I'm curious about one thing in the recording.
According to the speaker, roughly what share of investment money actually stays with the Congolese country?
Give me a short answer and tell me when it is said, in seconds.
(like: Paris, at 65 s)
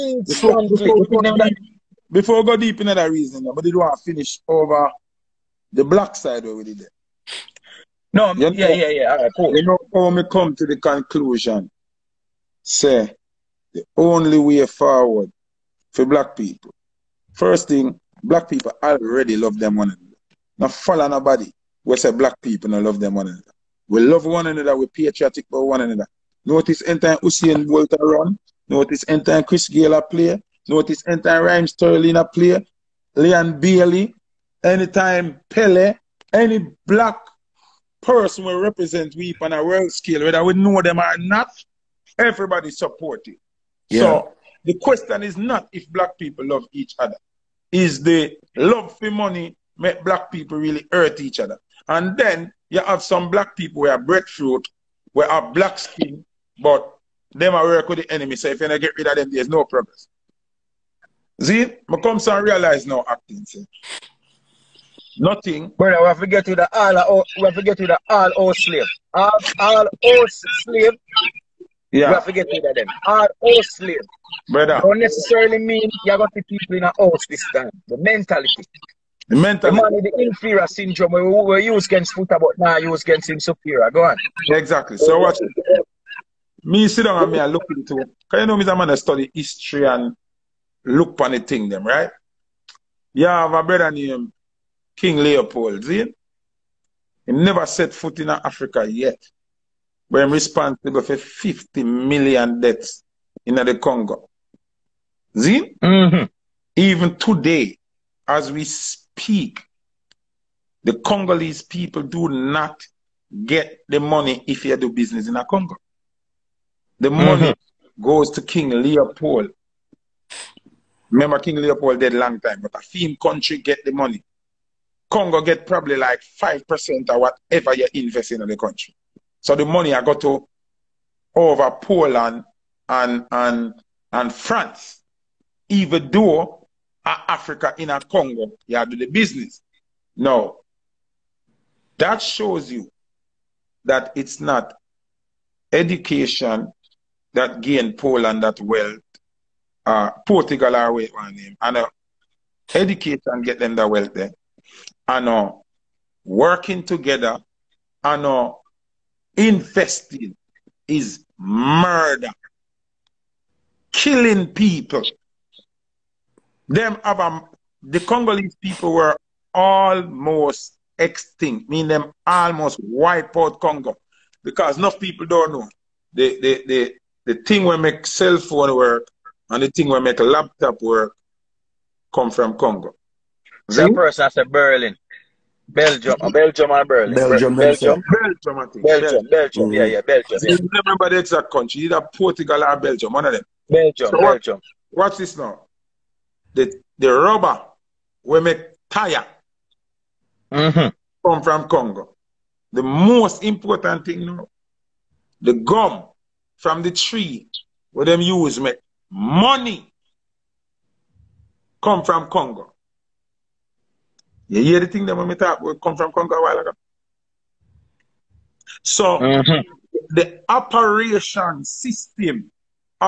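5%, at 126 s.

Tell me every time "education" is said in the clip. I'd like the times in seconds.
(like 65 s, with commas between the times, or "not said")
145 s, 152 s.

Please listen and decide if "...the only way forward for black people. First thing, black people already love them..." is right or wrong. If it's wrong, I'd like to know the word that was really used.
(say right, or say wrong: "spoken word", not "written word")
right.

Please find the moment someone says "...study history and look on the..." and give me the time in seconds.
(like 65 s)
88 s.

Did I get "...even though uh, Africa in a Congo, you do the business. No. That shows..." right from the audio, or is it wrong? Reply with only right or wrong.
right.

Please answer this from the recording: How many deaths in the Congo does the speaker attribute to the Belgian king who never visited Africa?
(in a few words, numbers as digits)
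50 million.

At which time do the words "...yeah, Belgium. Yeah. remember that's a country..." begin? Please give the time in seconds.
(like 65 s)
189 s.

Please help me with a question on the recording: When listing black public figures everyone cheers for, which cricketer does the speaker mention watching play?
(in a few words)
Chris Gayle.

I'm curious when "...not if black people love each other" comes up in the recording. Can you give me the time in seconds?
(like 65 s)
45 s.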